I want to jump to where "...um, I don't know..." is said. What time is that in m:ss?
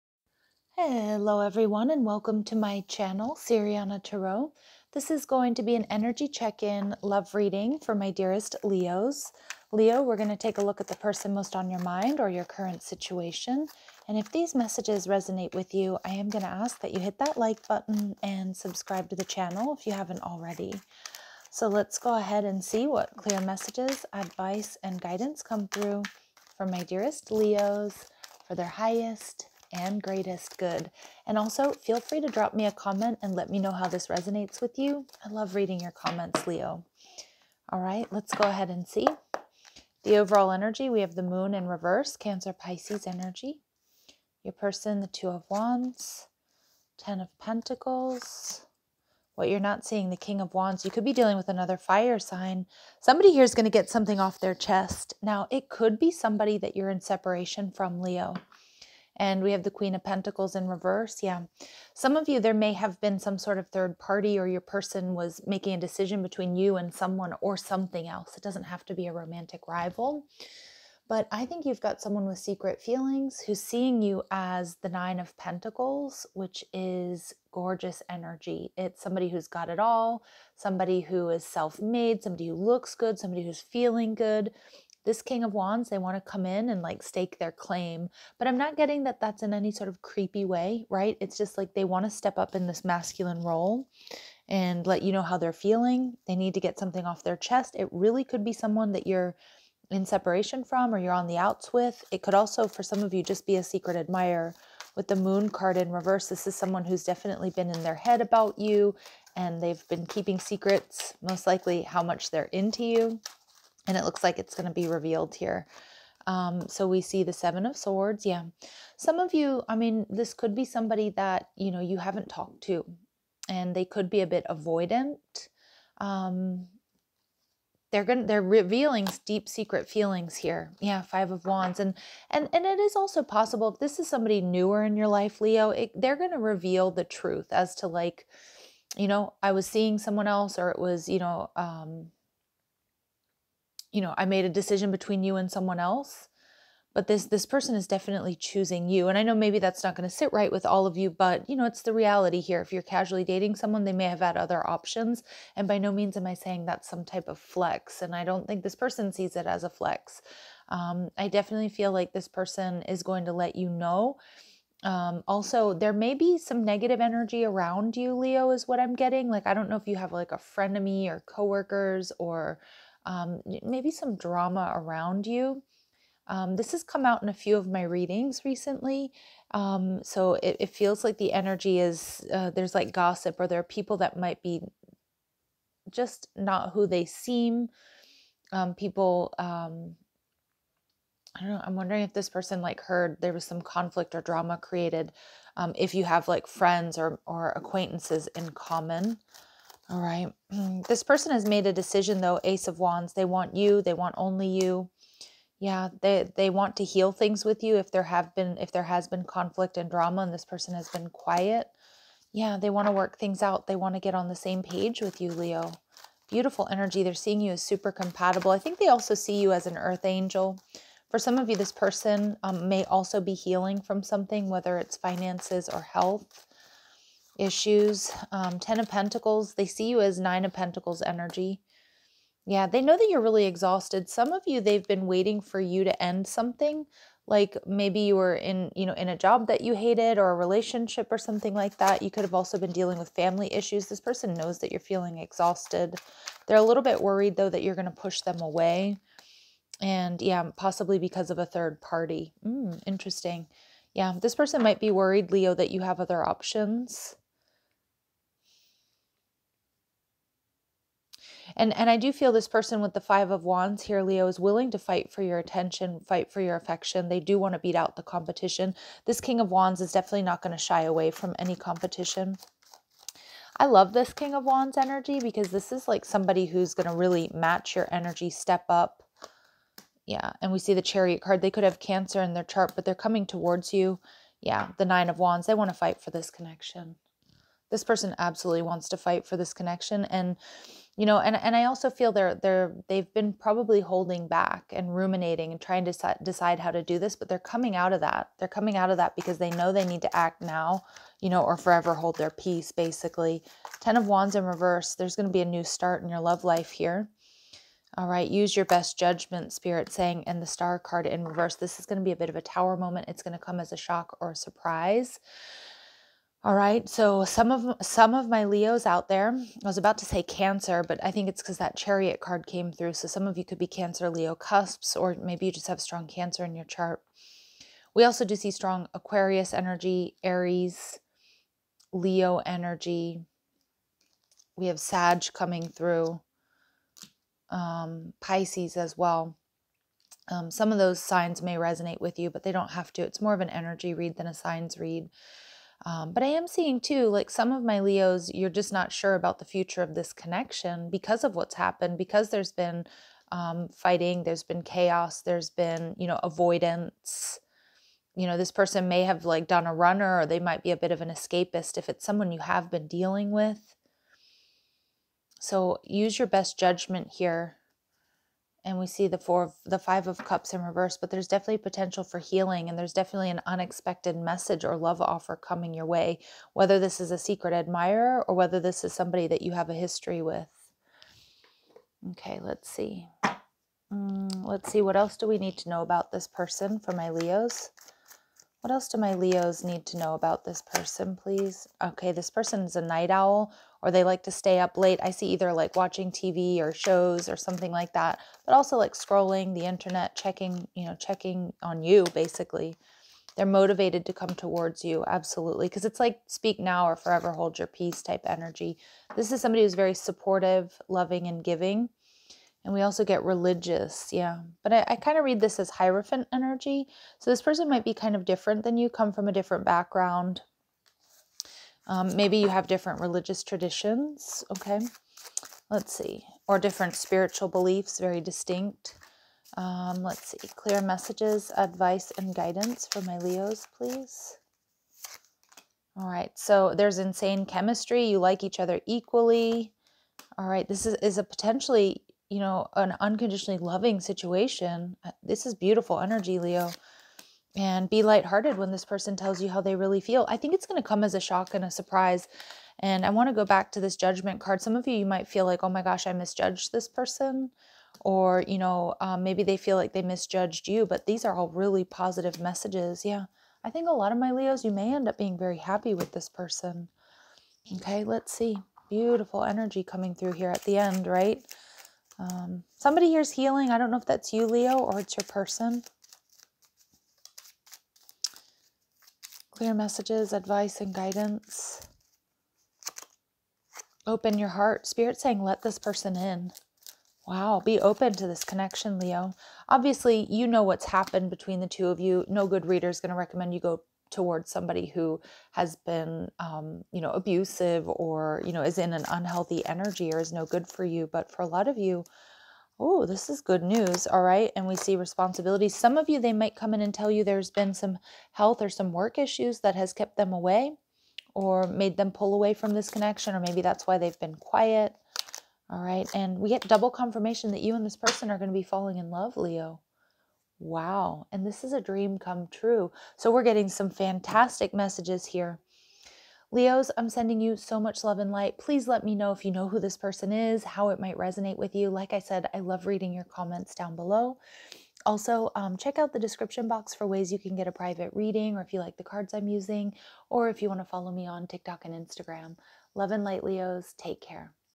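3:09.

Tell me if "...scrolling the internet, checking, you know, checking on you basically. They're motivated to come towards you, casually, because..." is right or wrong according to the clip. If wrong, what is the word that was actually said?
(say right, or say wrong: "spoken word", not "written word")
wrong: "absolutely", not "casually".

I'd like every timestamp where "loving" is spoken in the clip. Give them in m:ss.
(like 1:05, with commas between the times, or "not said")
6:50, 7:23.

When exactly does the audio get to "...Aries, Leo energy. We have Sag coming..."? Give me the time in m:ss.
5:30.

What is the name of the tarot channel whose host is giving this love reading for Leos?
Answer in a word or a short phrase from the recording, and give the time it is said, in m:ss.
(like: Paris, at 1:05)
Siriana Tarot, at 0:03.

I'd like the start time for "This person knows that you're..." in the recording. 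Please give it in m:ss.
4:03.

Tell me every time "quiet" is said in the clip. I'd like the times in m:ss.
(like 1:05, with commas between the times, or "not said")
3:31, 8:34.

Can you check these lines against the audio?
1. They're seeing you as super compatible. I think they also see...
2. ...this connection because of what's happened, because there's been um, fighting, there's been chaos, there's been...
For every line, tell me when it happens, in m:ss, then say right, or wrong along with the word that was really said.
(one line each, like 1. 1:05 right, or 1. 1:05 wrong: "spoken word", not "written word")
1. 3:37 right
2. 5:49 right.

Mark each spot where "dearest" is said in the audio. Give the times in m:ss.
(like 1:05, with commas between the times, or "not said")
0:08, 0:26.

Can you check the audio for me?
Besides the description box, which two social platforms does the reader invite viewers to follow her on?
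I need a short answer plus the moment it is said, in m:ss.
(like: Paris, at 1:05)
TikTok and Instagram, at 9:01.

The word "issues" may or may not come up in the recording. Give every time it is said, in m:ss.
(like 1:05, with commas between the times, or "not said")
3:47, 4:03, 8:29.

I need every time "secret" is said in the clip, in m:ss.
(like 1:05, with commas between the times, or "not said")
1:12, 1:43, 1:50, 2:09, 6:17.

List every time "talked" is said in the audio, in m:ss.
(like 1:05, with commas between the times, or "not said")
2:02.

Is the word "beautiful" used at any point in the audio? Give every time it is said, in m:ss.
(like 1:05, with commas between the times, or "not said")
3:36, 7:25, 7:48.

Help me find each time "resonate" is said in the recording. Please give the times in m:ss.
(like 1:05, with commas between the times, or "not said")
0:15, 0:34, 5:41, 8:51.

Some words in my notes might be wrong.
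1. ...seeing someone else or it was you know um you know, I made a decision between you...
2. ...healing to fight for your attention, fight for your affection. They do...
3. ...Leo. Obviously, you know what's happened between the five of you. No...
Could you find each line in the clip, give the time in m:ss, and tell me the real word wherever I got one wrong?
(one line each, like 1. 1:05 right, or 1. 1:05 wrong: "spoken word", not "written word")
1. 2:19 right
2. 4:24 wrong: "willing", not "healing"
3. 8:08 wrong: "two", not "five".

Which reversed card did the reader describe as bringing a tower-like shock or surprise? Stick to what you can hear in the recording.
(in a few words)
The Star.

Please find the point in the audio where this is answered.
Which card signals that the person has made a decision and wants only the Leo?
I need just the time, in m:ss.
3:22.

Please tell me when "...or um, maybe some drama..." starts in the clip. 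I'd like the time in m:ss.
2:52.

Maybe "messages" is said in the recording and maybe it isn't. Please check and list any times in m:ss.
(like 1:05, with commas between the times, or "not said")
0:14, 0:23, 6:14, 7:10, 7:42, 7:59, 8:44.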